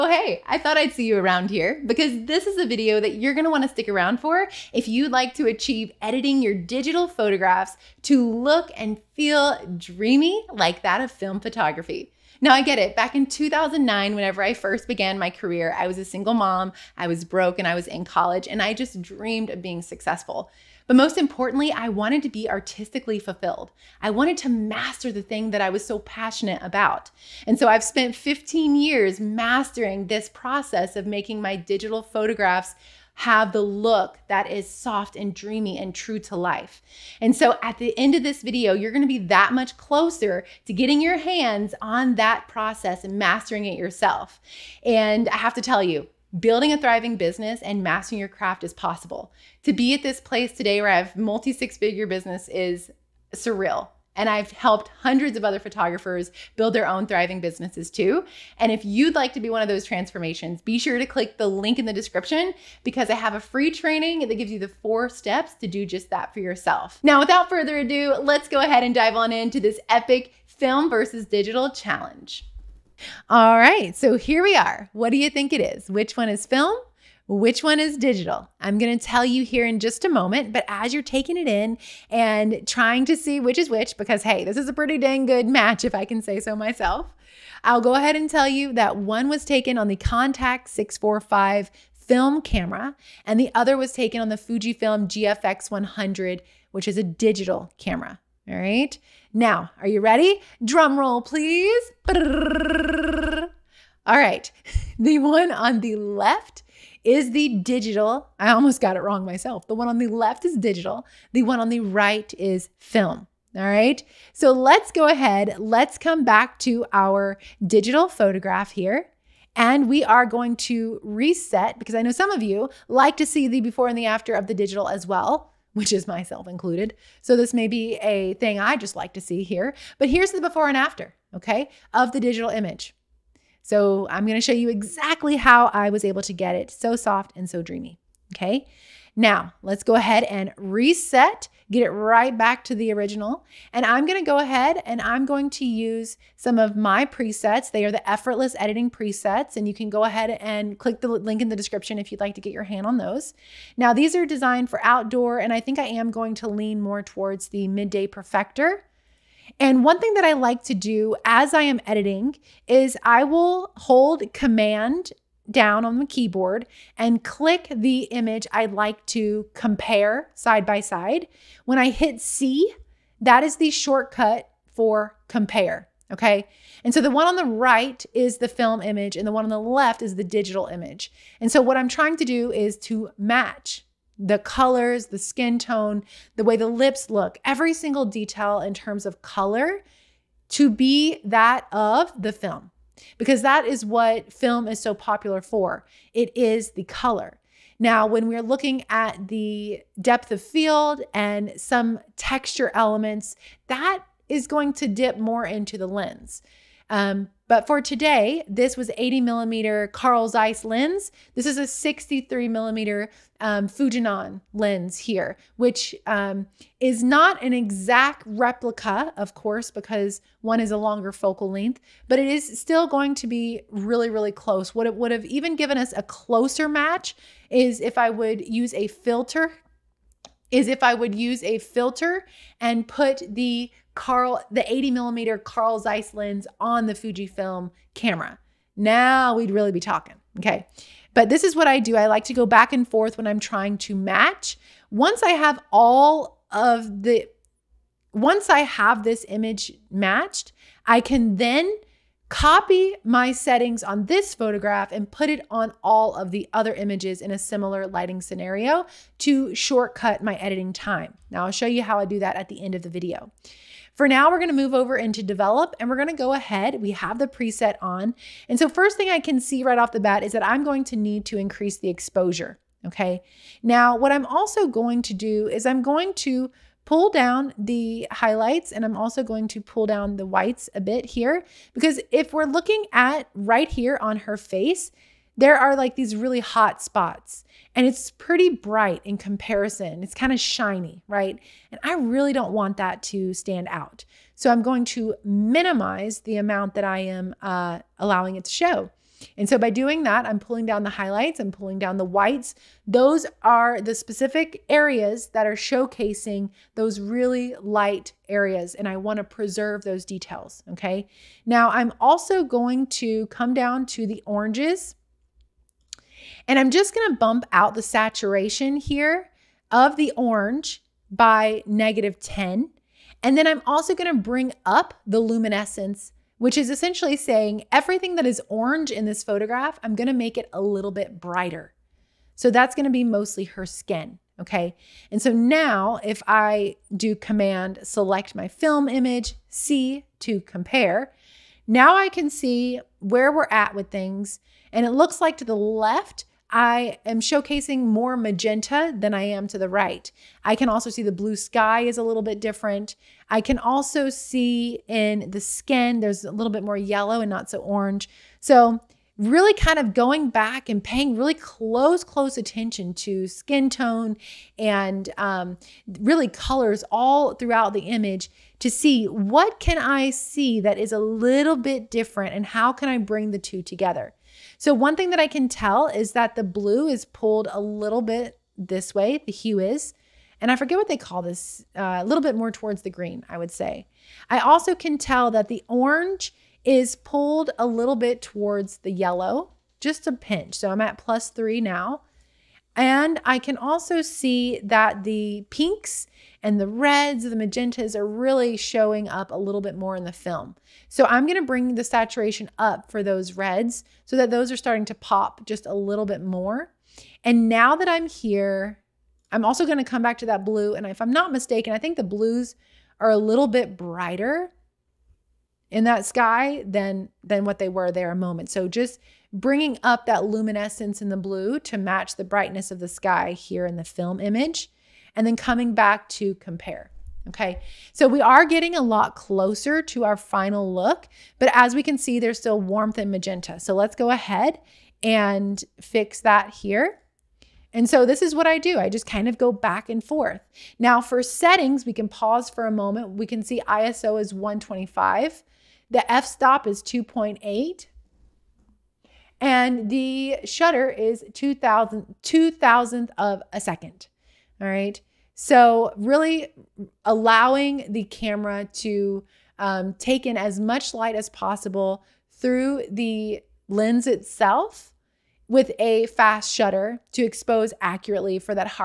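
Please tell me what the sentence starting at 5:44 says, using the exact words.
And it looks like to the left, I am showcasing more magenta than I am to the right.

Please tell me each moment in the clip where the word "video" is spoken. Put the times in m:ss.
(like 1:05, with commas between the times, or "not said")
0:02, 0:38, 4:22.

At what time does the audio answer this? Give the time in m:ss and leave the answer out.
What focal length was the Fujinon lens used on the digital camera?
3:31.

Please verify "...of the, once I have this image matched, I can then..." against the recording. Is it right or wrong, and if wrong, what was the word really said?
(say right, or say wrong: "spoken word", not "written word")
right.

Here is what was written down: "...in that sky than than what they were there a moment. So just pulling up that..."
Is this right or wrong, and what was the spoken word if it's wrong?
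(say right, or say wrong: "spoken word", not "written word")
wrong: "bringing", not "pulling".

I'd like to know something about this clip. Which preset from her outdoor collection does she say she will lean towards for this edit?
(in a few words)
midday perfector.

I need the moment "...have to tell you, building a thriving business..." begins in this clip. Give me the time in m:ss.
0:45.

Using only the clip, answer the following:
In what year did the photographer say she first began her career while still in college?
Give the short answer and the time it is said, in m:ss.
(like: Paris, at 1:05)
2009, at 0:13.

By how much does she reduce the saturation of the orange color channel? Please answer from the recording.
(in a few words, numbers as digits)
negative 10.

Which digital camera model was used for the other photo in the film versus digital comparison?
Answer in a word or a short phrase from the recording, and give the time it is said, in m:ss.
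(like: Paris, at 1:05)
Fujifilm GFX 100, at 1:34.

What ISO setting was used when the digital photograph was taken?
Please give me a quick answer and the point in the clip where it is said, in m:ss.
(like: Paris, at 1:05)
125, at 7:24.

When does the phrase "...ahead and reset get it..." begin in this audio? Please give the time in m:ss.
2:19.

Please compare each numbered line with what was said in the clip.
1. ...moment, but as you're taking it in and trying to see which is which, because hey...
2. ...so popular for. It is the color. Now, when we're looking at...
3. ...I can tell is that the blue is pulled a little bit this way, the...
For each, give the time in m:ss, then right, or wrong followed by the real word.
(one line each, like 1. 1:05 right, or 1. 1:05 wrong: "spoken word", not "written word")
1. 1:20 right
2. 3:14 right
3. 6:15 right.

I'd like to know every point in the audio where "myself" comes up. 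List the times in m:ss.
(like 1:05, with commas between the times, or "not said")
1:26, 1:49, 2:06.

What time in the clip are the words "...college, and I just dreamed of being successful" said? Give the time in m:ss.
0:18.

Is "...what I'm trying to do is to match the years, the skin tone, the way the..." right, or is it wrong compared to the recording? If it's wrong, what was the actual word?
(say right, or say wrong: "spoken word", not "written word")
wrong: "colors", not "years".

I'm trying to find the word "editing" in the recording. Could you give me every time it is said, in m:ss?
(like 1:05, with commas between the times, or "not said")
0:06, 2:28, 2:41, 4:20.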